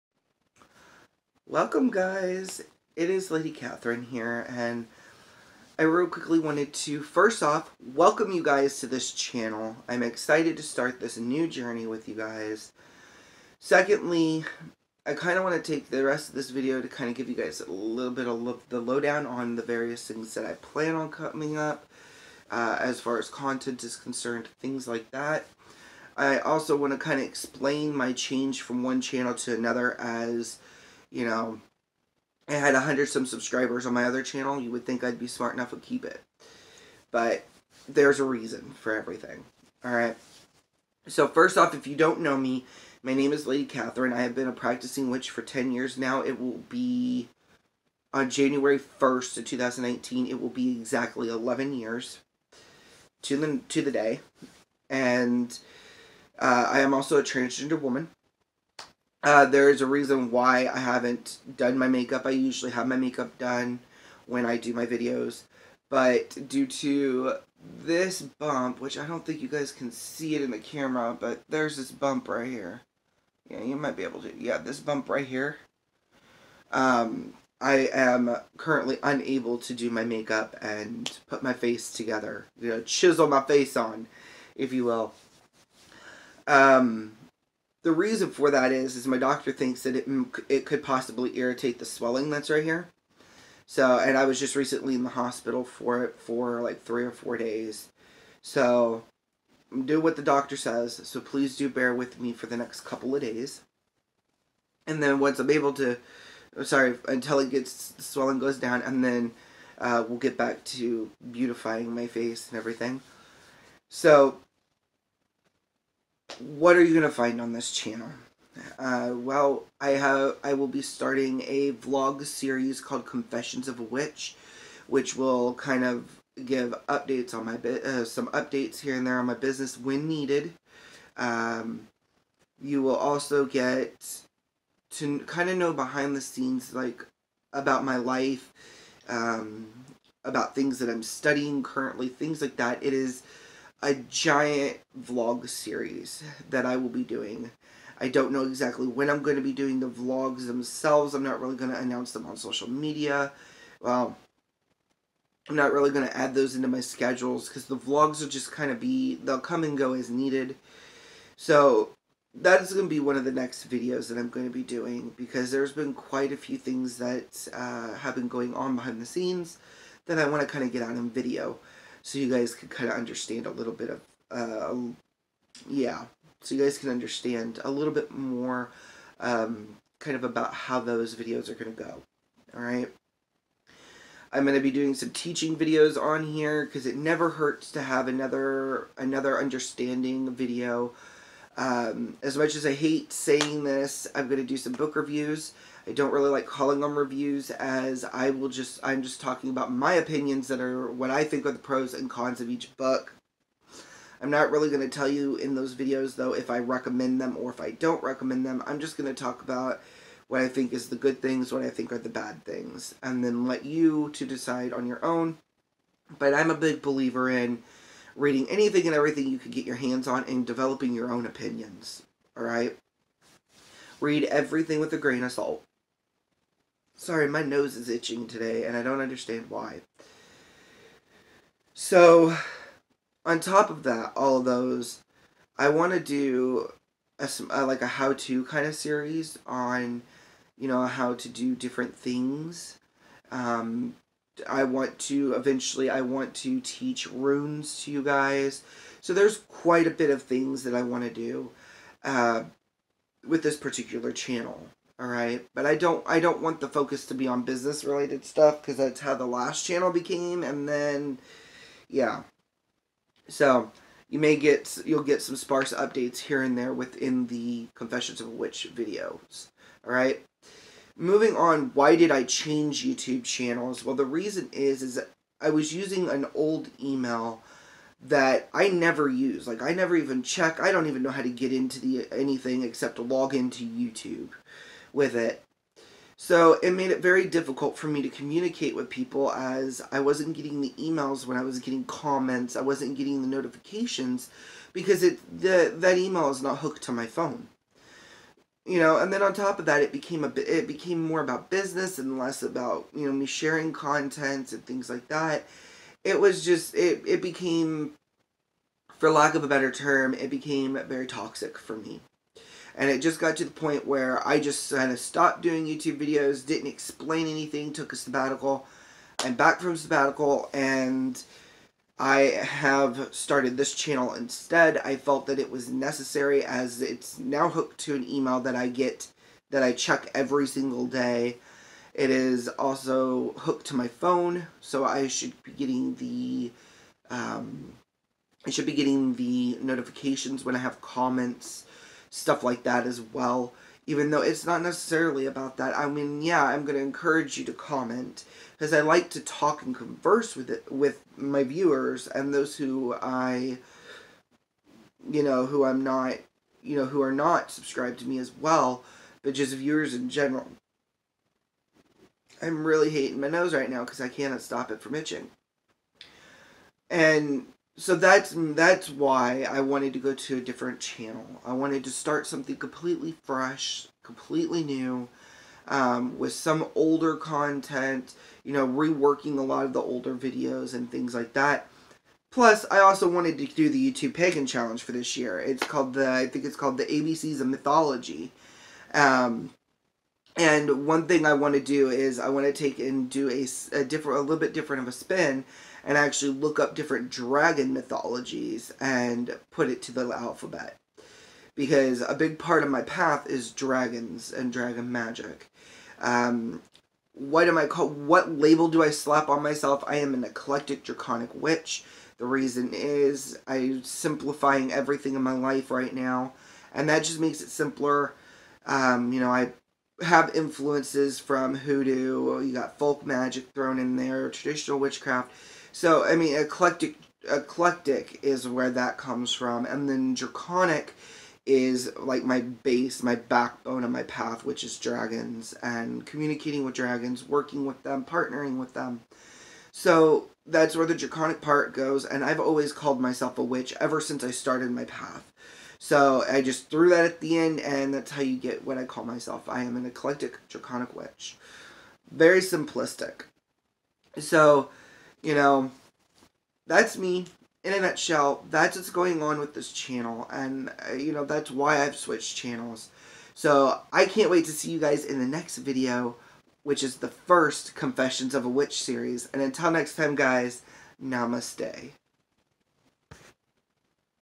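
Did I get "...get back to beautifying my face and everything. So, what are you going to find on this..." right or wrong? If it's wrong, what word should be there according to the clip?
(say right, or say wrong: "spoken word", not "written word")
right.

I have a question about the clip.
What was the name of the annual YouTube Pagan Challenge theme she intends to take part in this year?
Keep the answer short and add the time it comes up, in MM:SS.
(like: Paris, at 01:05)
ABCs of Mythology, at 06:26.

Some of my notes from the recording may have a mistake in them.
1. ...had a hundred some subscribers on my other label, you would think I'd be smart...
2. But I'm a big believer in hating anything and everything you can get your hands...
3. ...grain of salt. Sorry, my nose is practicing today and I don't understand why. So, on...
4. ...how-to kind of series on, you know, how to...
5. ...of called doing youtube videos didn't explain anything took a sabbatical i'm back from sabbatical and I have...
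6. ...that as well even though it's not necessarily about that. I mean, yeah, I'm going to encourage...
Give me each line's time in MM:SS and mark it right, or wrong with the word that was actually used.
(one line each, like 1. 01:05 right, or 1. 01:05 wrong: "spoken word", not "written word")
1. 00:32 wrong: "channel", not "label"
2. 03:36 wrong: "reading", not "hating"
3. 03:44 wrong: "itching", not "practicing"
4. 03:57 right
5. 05:14 wrong: "stopped", not "called"
6. 05:42 right.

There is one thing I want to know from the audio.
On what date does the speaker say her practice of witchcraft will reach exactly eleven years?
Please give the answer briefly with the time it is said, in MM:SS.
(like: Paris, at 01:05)
January 1st, 2019, at 00:48.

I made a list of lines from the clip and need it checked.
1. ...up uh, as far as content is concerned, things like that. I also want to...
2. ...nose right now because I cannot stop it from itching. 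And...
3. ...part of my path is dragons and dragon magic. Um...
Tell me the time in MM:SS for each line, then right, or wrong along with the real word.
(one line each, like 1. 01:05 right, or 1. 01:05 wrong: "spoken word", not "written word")
1. 00:21 right
2. 06:03 right
3. 06:42 right.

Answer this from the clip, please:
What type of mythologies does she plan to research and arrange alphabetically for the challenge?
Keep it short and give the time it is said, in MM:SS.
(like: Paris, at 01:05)
Dragon mythologies, at 06:37.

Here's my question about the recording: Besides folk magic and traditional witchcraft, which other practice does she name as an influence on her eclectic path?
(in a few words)
Hoodoo.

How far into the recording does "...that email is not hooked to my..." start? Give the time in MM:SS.
04:55.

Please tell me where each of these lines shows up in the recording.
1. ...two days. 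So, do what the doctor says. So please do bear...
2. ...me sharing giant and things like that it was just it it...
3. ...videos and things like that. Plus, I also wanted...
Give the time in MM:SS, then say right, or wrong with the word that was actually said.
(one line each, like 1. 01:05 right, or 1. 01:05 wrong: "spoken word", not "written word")
1. 01:37 wrong: "four", not "two"
2. 05:03 wrong: "content", not "giant"
3. 06:20 right.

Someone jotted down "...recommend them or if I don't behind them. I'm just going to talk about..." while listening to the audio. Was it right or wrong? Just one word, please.
wrong.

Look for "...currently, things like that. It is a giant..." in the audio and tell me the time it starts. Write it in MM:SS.
02:21.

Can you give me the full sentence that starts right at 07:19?
So that's where the draconic part goes, and I've always called myself a witch ever since I started my path.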